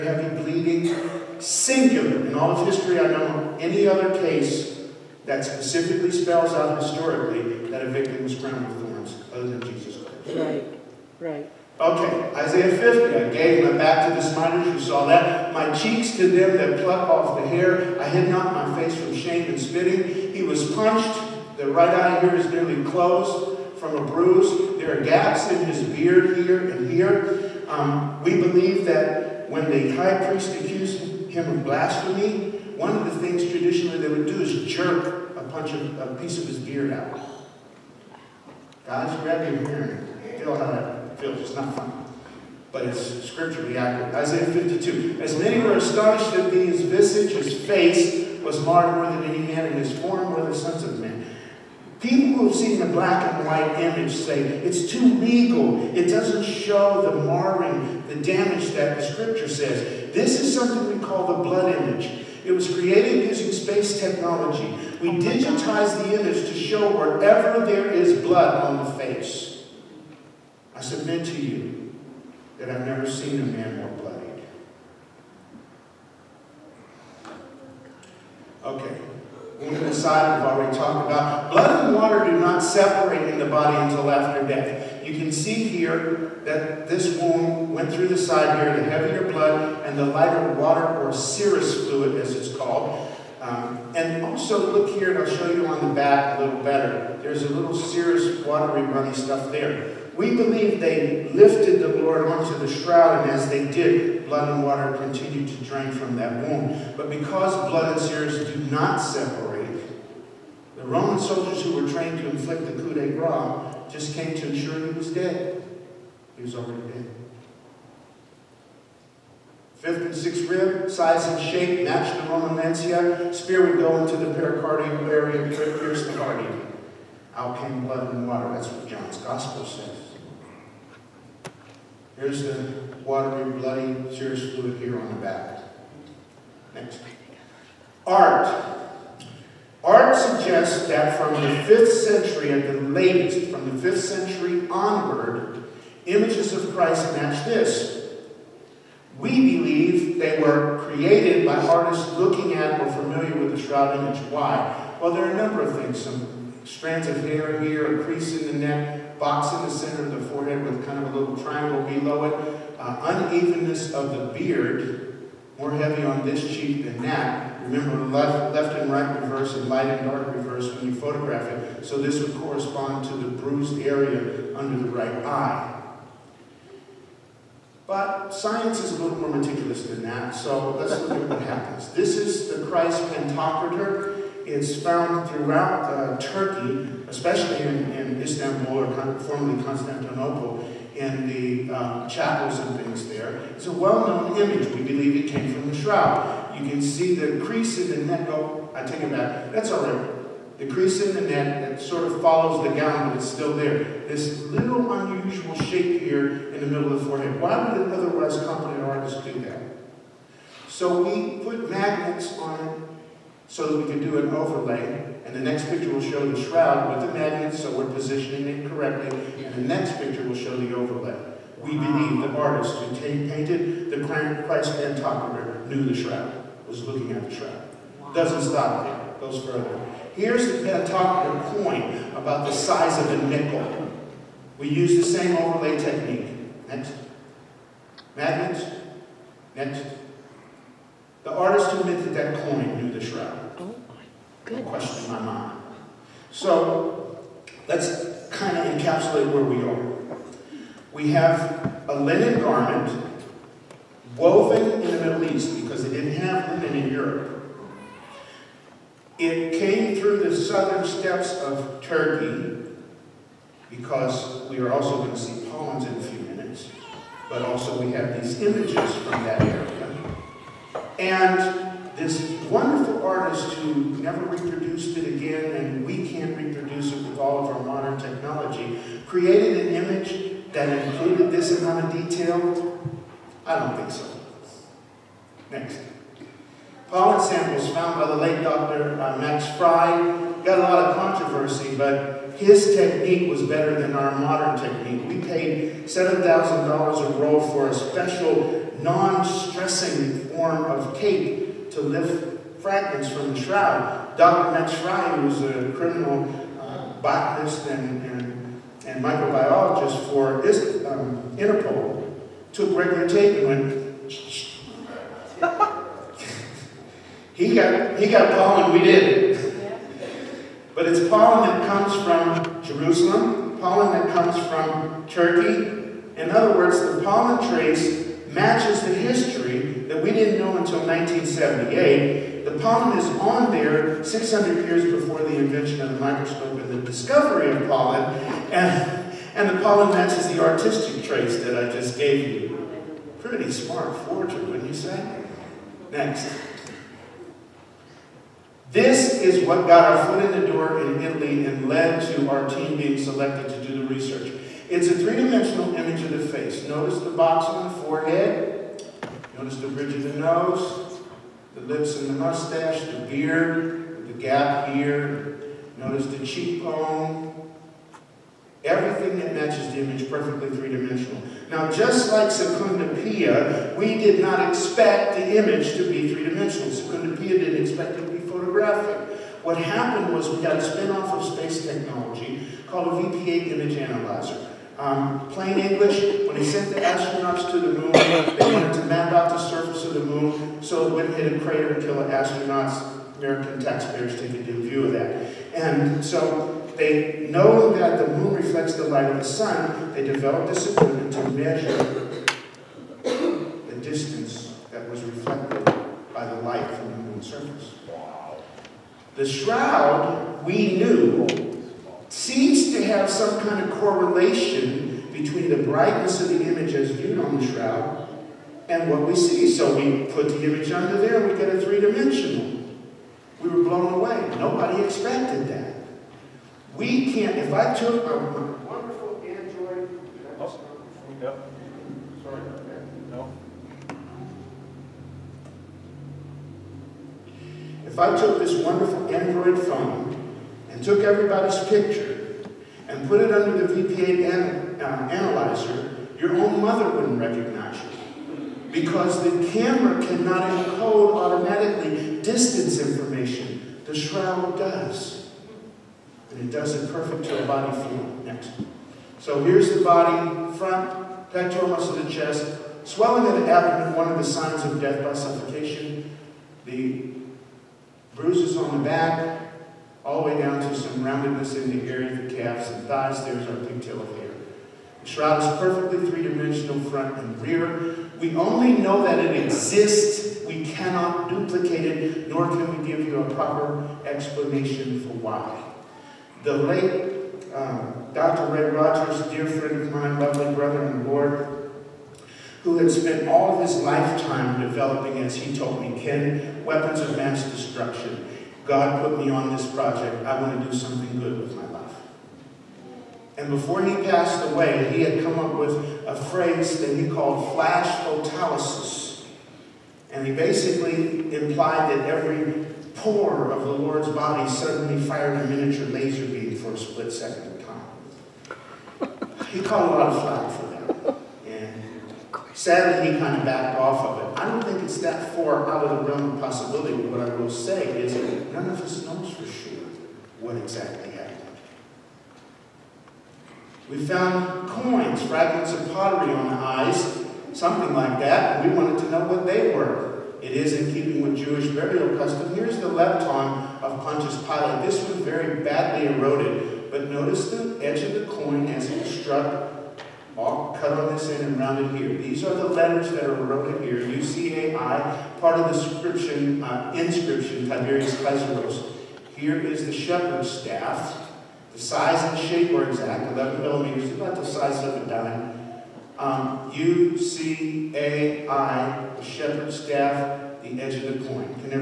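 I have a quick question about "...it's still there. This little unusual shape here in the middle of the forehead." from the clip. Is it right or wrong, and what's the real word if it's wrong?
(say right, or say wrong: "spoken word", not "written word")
right.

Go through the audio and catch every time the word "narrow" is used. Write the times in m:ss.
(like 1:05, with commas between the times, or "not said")
not said.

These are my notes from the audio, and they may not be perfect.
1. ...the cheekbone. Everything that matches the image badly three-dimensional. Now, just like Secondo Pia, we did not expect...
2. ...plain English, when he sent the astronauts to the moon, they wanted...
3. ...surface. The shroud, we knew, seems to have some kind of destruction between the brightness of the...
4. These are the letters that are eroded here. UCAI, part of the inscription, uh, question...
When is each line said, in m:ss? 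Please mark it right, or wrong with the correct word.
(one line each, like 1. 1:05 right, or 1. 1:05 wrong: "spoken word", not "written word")
1. 6:06 wrong: "perfectly", not "badly"
2. 6:25 right
3. 6:47 wrong: "correlation", not "destruction"
4. 9:12 wrong: "inscription", not "question".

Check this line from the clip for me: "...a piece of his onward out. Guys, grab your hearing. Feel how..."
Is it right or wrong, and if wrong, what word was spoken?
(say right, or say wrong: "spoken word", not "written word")
wrong: "beard", not "onward".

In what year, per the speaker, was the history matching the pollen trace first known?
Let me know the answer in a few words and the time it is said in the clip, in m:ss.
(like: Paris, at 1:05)
1978, at 5:30.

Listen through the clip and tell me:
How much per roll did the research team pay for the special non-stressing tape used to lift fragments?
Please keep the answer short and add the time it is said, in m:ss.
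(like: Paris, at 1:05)
$7,000, at 4:55.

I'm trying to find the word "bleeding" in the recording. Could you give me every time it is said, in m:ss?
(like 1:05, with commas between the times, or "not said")
0:00.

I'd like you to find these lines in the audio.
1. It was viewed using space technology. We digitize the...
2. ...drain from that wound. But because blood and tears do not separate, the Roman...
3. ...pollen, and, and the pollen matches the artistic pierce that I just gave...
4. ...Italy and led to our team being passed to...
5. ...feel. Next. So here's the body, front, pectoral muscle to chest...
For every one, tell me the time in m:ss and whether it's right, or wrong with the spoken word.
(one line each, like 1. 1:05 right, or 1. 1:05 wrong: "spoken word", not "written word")
1. 1:02 wrong: "created", not "viewed"
2. 1:45 right
3. 5:37 wrong: "trace", not "pierce"
4. 5:51 wrong: "selected", not "passed"
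5. 7:37 right.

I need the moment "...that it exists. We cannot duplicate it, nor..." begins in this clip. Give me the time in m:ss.
7:59.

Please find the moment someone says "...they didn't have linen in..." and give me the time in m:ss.
4:15.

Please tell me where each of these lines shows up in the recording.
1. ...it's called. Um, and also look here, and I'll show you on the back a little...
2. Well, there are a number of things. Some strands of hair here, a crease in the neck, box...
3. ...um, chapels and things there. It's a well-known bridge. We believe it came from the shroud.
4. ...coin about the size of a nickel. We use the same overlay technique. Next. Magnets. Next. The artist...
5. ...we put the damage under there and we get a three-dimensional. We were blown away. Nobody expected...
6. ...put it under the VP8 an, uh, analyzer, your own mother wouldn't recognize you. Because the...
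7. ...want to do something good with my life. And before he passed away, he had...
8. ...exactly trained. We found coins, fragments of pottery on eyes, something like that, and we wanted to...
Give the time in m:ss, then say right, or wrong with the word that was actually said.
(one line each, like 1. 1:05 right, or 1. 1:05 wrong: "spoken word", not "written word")
1. 1:32 right
2. 2:34 right
3. 3:11 wrong: "image", not "bridge"
4. 3:51 right
5. 6:59 wrong: "image", not "damage"
6. 7:23 right
7. 8:20 right
8. 8:50 wrong: "happened", not "trained".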